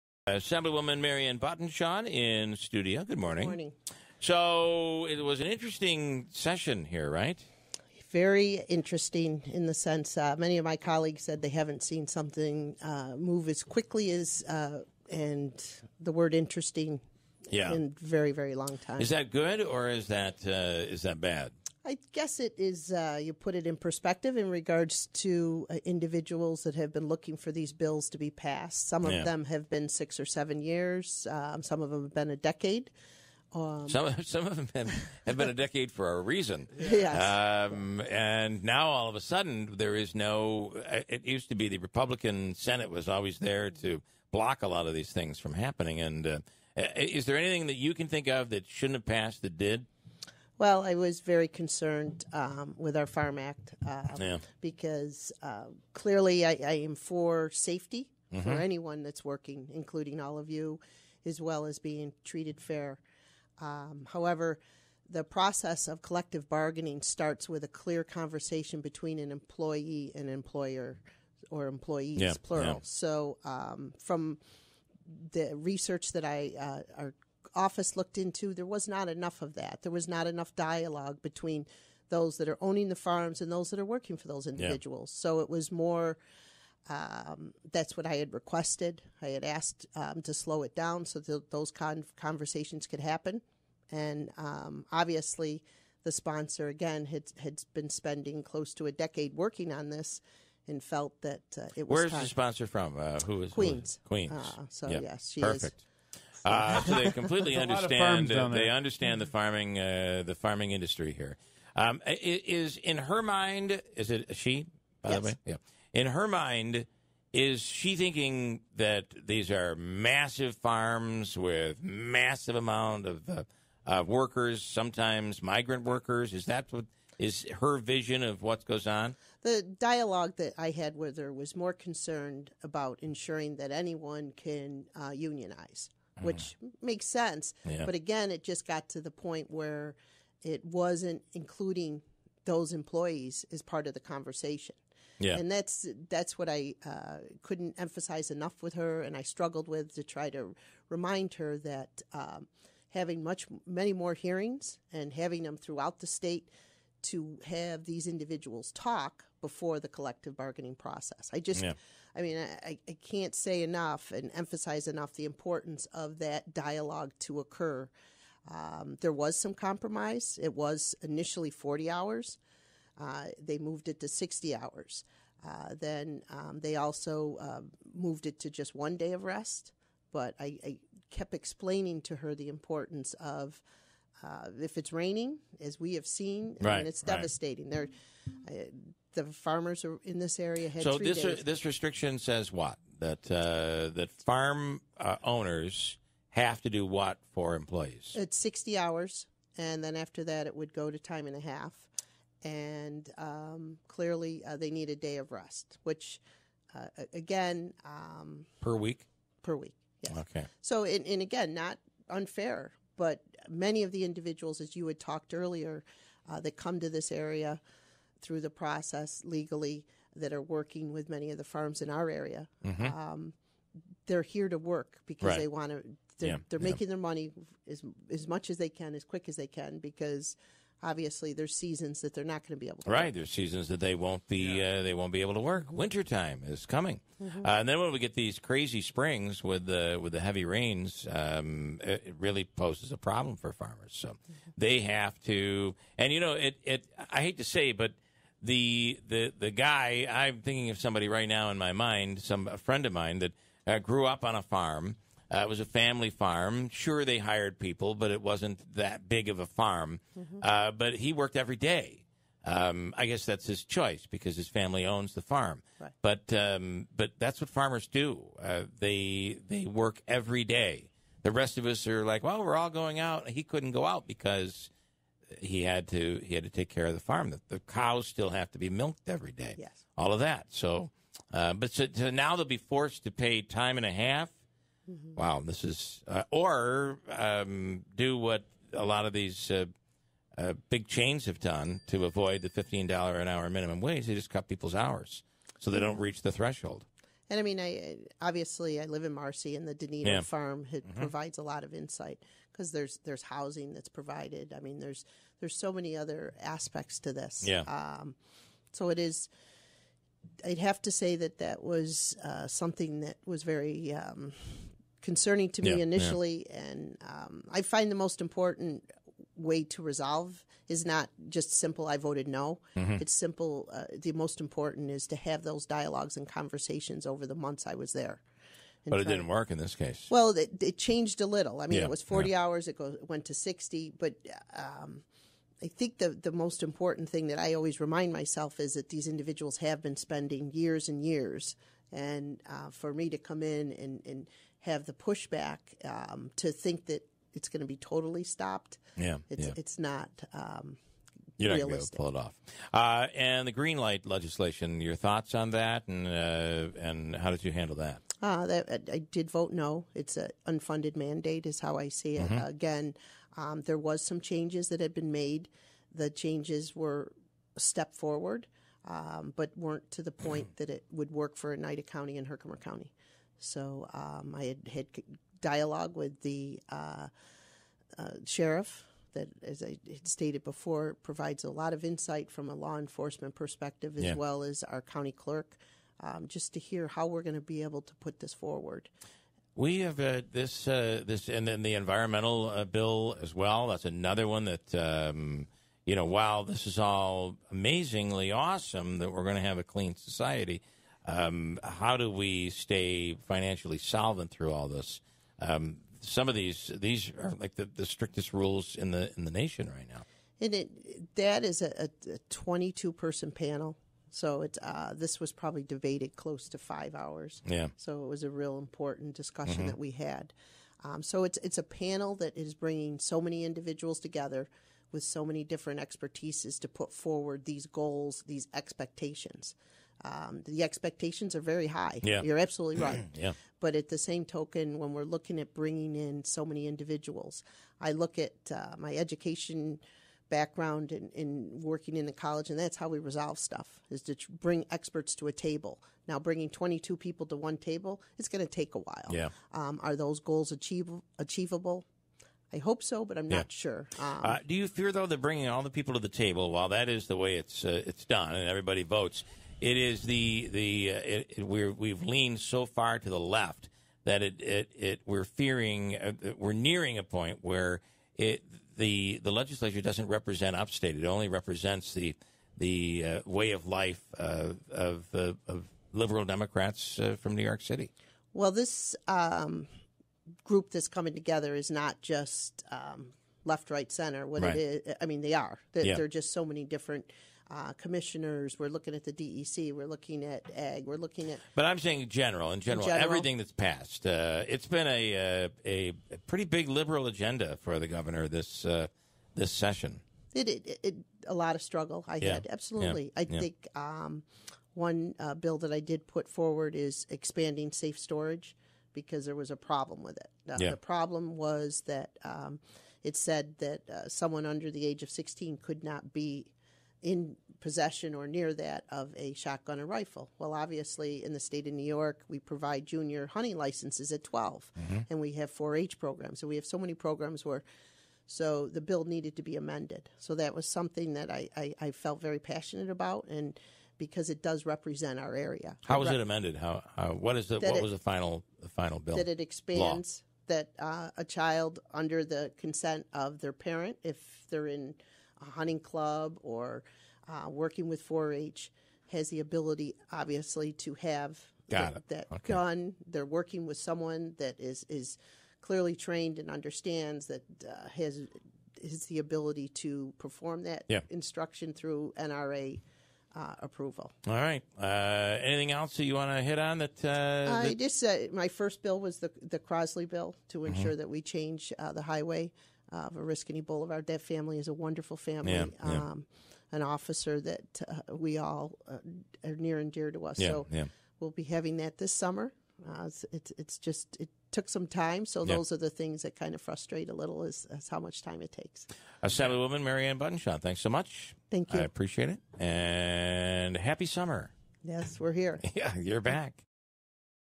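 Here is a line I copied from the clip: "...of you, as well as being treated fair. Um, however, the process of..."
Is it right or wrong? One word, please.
right.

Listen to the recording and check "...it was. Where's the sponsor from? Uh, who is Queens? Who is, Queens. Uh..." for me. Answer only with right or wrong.
right.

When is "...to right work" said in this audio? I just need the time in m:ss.
3:52.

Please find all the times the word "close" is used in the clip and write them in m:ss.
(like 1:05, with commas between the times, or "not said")
1:38, 6:56.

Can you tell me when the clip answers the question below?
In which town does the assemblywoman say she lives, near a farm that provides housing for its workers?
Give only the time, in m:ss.
4:59.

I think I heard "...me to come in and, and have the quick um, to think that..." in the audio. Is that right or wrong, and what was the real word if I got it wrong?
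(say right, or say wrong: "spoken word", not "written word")
wrong: "pushback", not "quick".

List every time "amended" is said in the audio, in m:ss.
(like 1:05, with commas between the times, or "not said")
8:49, 8:56.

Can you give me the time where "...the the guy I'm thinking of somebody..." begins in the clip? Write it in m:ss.
4:09.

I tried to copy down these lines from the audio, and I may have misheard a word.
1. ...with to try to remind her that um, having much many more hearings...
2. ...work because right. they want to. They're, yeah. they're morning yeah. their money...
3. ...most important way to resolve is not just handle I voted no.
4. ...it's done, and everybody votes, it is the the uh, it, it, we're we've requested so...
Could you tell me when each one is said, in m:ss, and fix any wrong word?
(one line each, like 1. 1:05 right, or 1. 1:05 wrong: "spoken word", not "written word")
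1. 2:29 right
2. 3:44 wrong: "making", not "morning"
3. 5:17 wrong: "simple", not "handle"
4. 7:37 wrong: "leaned", not "requested".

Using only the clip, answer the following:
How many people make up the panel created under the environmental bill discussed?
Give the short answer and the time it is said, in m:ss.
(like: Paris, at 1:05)
22, at 6:52.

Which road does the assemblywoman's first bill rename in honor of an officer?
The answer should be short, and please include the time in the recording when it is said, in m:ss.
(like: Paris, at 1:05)
Oriskany Boulevard, at 9:33.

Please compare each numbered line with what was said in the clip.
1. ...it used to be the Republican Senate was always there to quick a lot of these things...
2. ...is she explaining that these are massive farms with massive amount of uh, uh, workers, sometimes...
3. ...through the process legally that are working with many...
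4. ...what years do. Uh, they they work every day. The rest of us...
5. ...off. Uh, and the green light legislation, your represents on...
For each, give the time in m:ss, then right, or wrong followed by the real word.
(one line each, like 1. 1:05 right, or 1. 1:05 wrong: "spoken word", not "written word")
1. 0:41 wrong: "block", not "quick"
2. 1:57 wrong: "thinking", not "explaining"
3. 3:38 right
4. 4:27 wrong: "farmers", not "years"
5. 5:52 wrong: "thoughts", not "represents".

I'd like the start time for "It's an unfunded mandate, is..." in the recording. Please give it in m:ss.
5:59.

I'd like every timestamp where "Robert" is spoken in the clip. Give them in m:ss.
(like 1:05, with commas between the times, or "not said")
not said.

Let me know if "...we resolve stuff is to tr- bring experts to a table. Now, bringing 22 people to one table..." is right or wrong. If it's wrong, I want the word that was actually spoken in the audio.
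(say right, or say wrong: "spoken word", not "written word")
right.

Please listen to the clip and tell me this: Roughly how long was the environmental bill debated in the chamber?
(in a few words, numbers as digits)
five hours.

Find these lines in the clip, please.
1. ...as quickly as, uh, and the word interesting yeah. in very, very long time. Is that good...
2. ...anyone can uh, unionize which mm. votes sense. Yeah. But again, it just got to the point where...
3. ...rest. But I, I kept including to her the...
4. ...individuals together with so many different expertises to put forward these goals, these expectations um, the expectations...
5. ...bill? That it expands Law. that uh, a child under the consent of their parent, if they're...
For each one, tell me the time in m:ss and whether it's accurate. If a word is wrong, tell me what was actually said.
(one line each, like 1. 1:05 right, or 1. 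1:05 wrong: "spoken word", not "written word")
1. 0:13 right
2. 2:13 wrong: "makes", not "votes"
3. 2:59 wrong: "explaining", not "including"
4. 7:03 right
5. 8:58 right.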